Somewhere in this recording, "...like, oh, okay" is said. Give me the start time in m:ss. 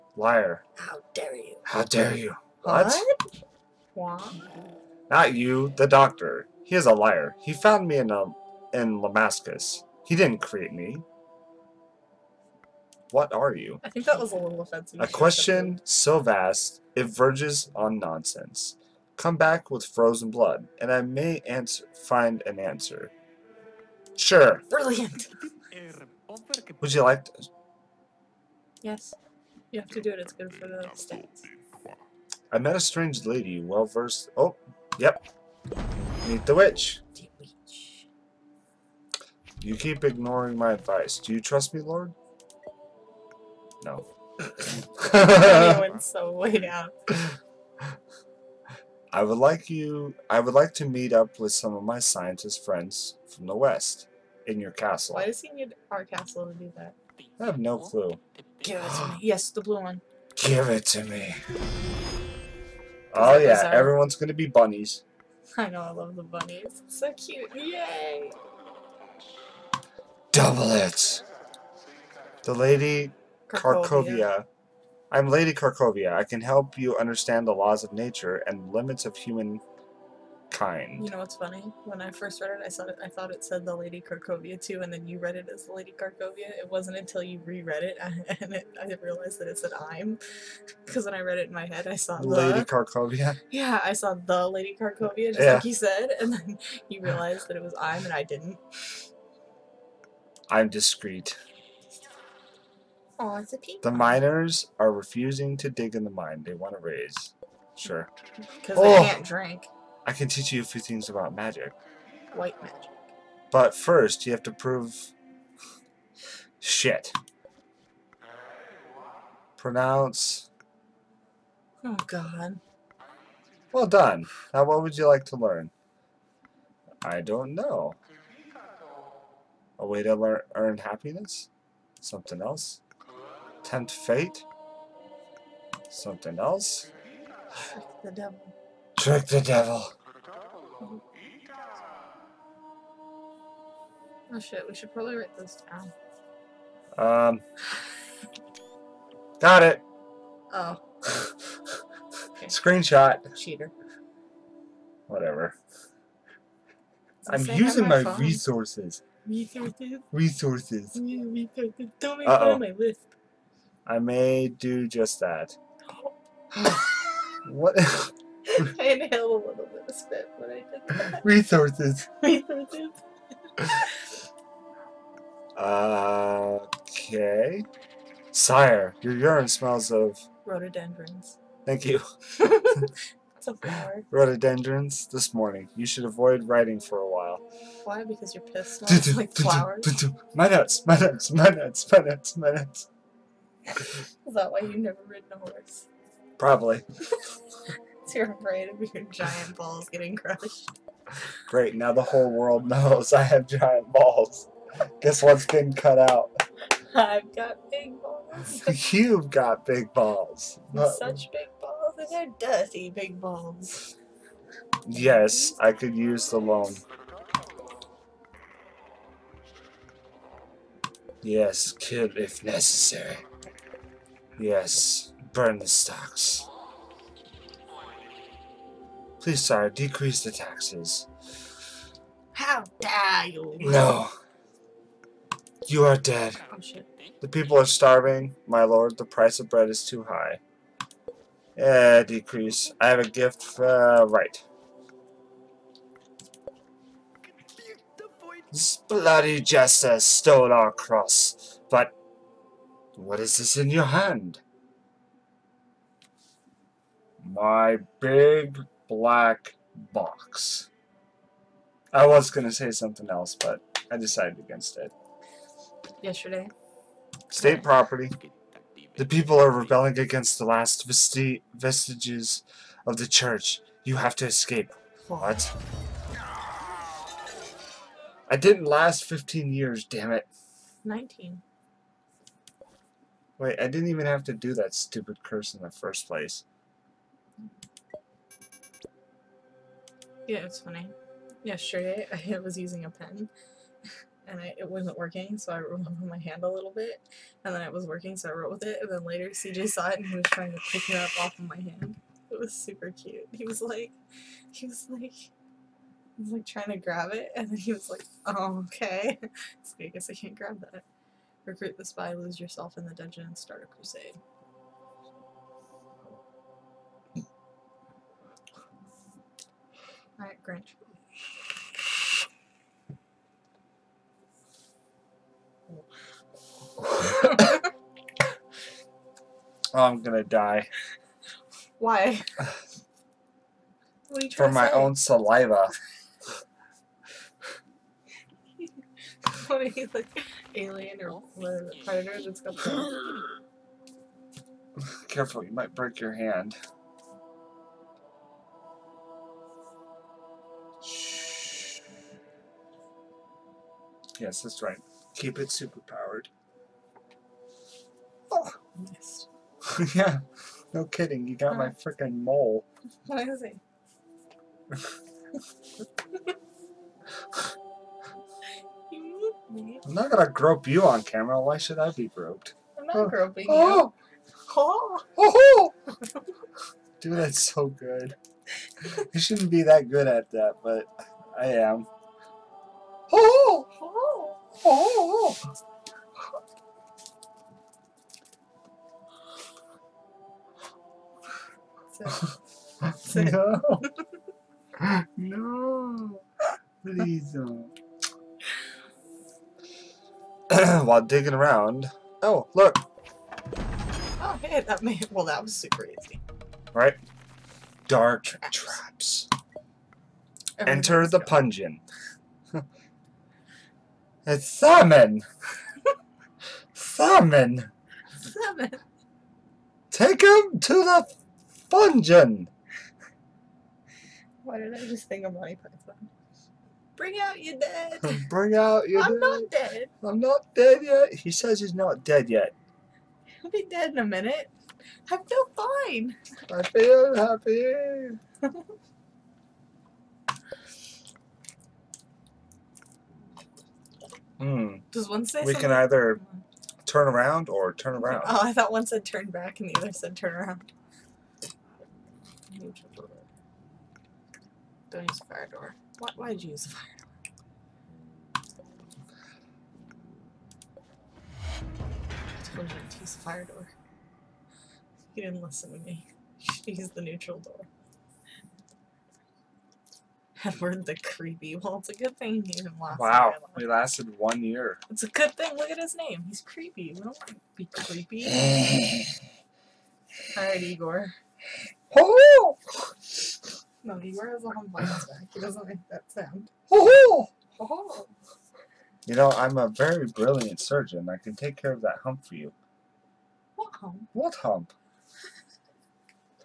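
5:07.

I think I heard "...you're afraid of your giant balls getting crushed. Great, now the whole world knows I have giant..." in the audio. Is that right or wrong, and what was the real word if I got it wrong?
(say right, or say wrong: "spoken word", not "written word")
right.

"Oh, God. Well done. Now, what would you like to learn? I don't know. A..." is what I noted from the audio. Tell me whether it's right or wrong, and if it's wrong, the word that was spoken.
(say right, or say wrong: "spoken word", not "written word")
right.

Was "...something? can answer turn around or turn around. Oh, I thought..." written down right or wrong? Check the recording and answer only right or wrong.
wrong.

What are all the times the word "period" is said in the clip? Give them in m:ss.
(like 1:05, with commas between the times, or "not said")
not said.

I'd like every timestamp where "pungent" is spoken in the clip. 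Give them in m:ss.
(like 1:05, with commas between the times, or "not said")
6:51.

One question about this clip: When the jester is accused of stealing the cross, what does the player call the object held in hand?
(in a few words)
big black box.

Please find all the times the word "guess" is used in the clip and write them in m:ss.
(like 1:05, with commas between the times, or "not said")
3:25, 5:09.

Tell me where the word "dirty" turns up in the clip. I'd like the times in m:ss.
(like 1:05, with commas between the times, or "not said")
3:32.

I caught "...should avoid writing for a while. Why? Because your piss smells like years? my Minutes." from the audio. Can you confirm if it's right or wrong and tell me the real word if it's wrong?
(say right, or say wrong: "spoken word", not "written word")
wrong: "flowers", not "years".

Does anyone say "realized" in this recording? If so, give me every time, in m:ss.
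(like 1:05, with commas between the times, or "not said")
1:29, 1:37.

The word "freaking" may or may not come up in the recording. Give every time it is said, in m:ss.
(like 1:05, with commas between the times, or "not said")
6:01.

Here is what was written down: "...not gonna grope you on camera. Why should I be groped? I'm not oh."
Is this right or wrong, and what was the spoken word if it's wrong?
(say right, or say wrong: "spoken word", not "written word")
right.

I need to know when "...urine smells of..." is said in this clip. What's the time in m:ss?
2:59.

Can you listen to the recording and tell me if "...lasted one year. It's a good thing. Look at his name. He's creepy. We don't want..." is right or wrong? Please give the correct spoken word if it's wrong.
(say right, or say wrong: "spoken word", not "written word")
right.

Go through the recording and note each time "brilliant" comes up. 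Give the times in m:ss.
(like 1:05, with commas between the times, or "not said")
0:24, 8:10.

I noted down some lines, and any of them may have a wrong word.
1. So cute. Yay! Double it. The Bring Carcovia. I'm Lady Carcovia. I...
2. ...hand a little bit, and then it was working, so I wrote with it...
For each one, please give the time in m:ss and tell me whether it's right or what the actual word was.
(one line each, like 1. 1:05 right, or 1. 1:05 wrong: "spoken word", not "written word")
1. 1:06 wrong: "Lady", not "Bring"
2. 4:56 right.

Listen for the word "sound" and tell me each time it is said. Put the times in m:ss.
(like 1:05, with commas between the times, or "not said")
8:06.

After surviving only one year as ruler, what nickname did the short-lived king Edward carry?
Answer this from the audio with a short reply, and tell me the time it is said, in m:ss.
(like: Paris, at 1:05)
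the creepy, at 7:50.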